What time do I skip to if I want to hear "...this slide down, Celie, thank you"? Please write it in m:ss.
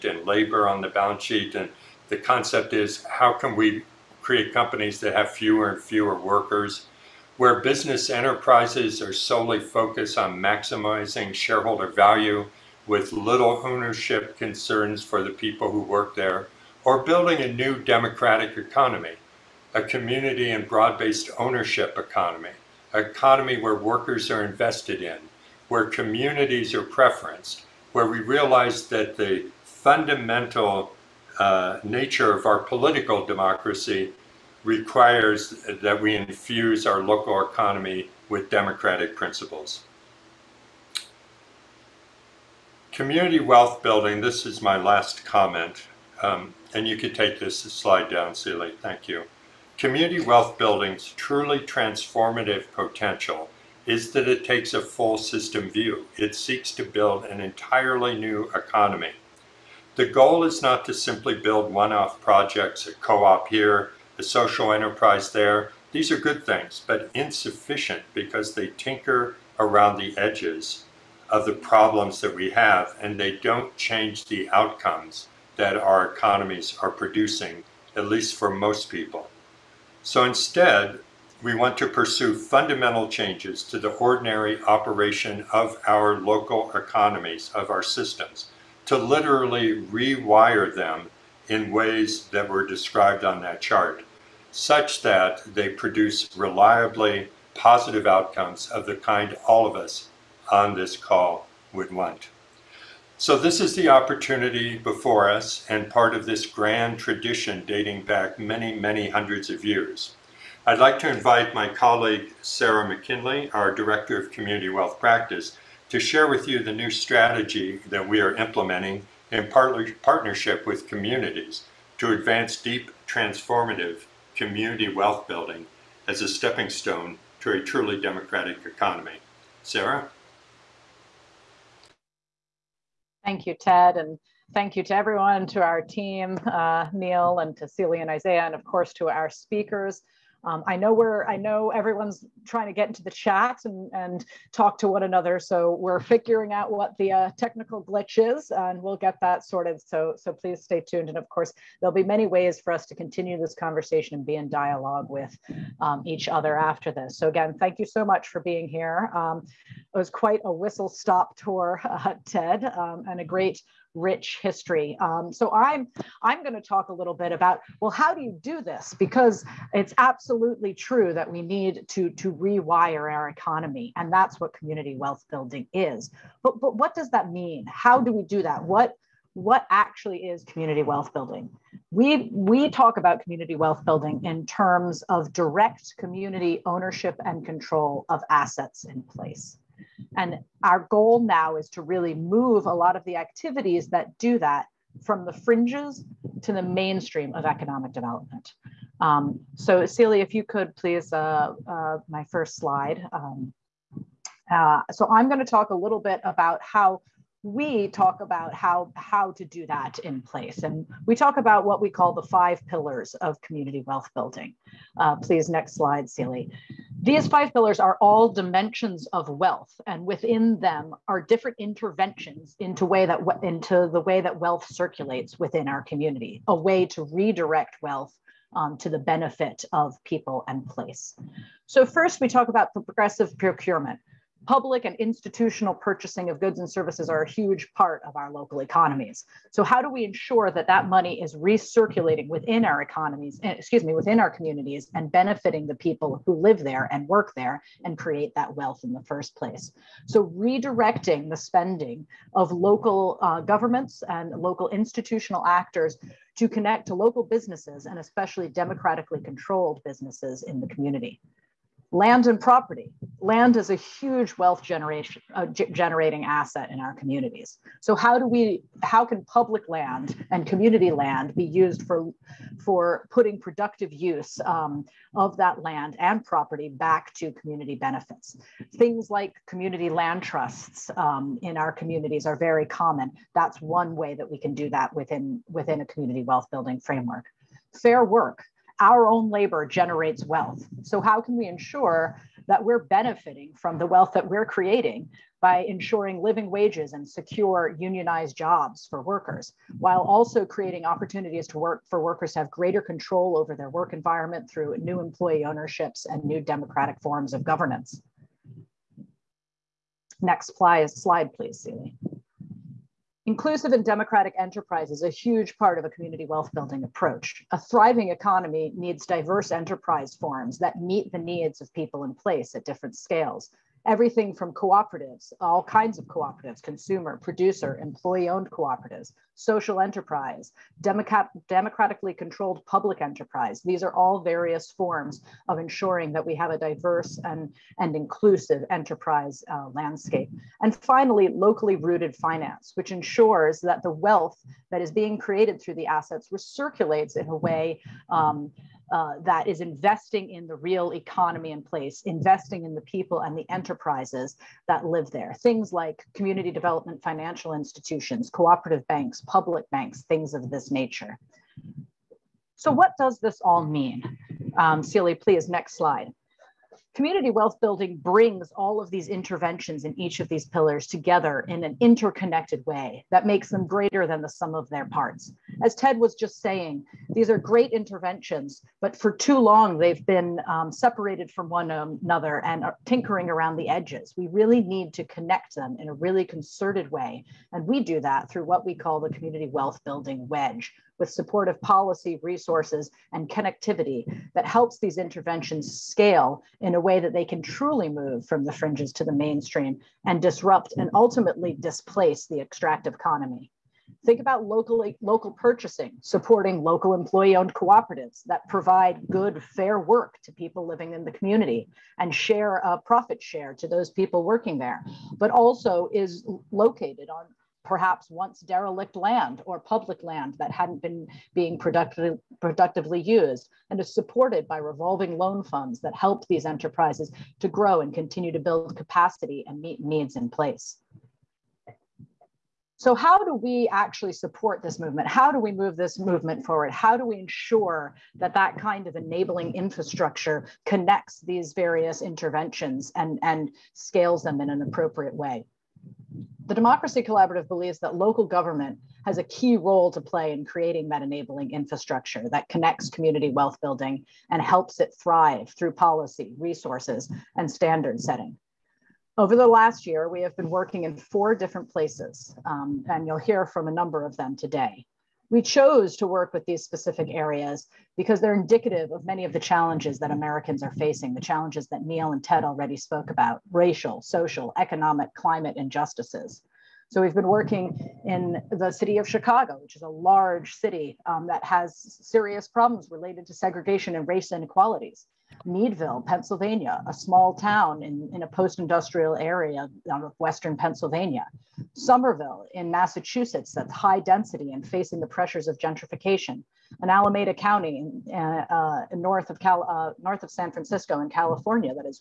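0:47.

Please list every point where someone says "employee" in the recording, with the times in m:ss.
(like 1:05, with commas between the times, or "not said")
5:04, 5:27, 6:46.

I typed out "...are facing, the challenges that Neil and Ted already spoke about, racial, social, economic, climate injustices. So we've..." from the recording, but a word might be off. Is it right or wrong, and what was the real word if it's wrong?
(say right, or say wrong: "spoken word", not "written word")
right.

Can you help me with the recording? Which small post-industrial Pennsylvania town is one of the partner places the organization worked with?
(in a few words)
Meadville.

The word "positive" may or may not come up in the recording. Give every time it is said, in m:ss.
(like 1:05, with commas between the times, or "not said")
1:37.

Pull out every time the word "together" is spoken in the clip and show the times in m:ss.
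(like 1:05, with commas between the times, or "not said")
6:10.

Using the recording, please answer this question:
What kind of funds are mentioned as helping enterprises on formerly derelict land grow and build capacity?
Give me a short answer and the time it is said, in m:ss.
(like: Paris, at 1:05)
revolving loan funds, at 7:04.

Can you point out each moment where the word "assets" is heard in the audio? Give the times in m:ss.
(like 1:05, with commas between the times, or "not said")
3:08, 4:26, 5:45.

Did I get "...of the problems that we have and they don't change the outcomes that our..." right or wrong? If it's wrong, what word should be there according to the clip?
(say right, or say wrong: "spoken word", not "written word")
right.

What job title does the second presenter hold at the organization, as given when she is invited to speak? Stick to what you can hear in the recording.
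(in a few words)
Director of Community Wealth Practice.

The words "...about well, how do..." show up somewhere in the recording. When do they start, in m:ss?
2:47.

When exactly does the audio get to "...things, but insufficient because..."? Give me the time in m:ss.
1:06.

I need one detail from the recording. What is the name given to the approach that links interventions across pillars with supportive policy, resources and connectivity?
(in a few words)
community wealth building wedge.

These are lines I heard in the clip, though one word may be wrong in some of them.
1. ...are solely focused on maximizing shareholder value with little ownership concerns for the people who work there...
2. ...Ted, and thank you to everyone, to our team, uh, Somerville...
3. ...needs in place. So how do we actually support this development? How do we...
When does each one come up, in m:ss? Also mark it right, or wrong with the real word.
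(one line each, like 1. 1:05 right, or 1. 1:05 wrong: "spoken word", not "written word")
1. 0:08 right
2. 2:13 wrong: "Neil", not "Somerville"
3. 7:09 wrong: "movement", not "development".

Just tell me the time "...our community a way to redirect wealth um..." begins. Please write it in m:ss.
3:45.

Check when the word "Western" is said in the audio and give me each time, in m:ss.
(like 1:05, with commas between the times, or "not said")
8:10.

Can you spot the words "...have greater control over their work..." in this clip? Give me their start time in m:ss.
5:02.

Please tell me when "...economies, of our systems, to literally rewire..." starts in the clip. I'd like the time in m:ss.
1:26.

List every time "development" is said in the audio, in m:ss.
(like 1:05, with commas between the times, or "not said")
3:17, 5:56.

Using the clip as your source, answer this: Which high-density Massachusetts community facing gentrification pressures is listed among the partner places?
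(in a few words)
Somerville.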